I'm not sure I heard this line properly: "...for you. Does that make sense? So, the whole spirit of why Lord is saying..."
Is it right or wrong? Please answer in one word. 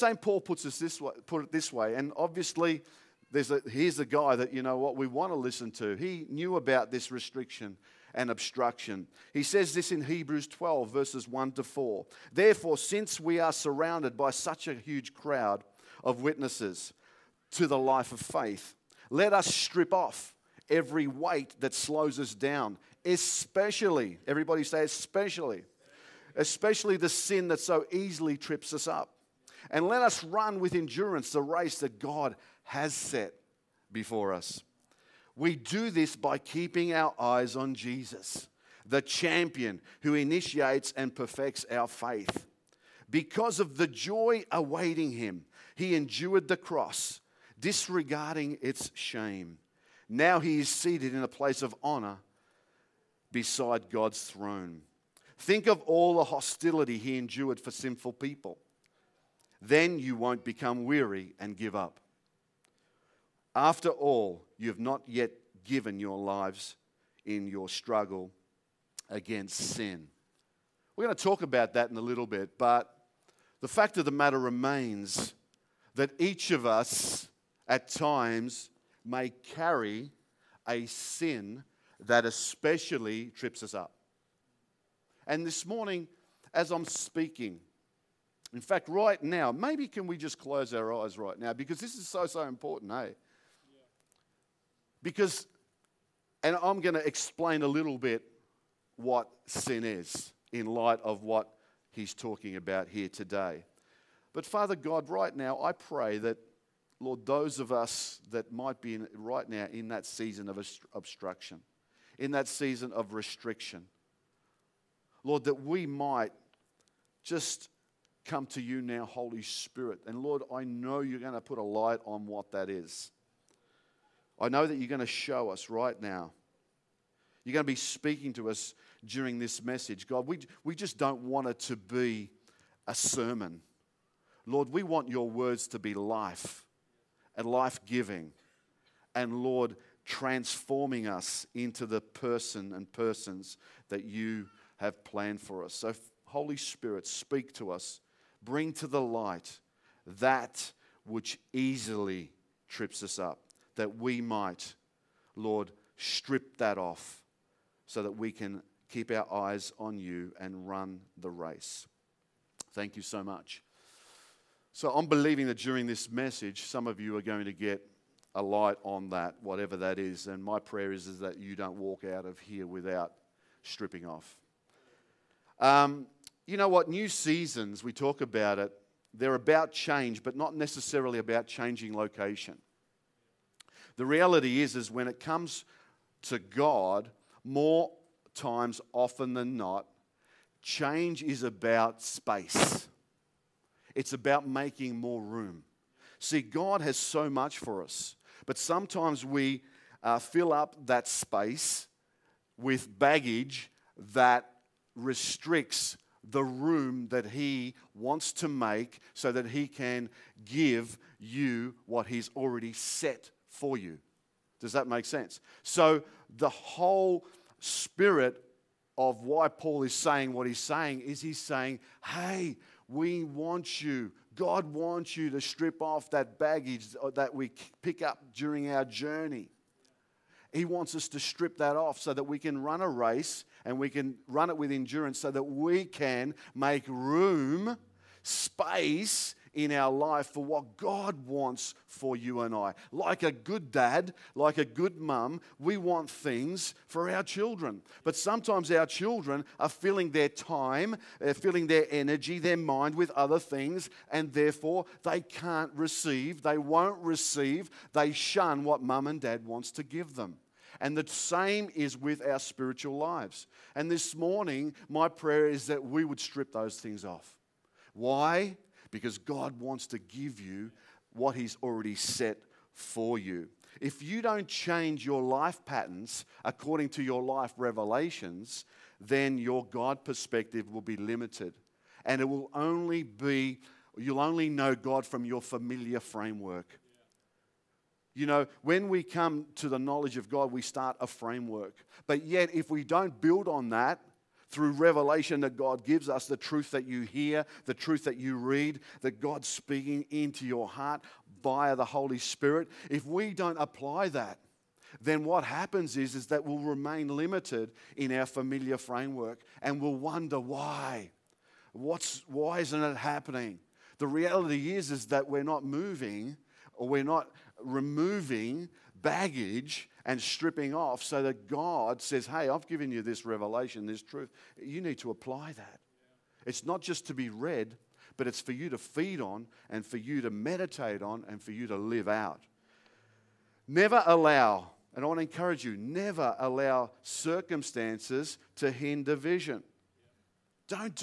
wrong.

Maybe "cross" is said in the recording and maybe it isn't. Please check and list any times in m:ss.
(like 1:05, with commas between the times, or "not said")
0:46.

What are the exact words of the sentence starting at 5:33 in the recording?
Never allow, and I want to encourage you, never allow circumstances to hinder vision.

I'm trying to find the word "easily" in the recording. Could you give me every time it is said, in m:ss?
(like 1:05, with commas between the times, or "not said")
0:27, 2:31.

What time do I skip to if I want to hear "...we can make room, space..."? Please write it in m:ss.
3:55.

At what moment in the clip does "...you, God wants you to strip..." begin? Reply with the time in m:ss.
3:43.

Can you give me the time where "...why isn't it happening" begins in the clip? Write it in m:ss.
5:12.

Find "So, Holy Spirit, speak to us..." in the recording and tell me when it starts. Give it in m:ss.
2:25.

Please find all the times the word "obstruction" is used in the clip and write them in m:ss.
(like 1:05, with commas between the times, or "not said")
0:08, 1:50.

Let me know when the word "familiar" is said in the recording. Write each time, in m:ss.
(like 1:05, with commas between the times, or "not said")
4:45, 5:08.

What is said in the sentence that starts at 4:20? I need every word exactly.
And the same is with our spiritual lives.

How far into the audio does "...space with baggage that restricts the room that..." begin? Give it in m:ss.
3:21.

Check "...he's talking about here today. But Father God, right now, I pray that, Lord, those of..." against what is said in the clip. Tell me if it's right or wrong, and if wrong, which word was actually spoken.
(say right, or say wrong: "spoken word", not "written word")
right.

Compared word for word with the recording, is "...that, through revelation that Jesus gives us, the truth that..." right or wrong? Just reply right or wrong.
wrong.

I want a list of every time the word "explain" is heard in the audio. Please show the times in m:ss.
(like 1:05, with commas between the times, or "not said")
1:37.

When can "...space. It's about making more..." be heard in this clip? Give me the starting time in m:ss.
3:12.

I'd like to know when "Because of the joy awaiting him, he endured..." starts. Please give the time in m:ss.
0:43.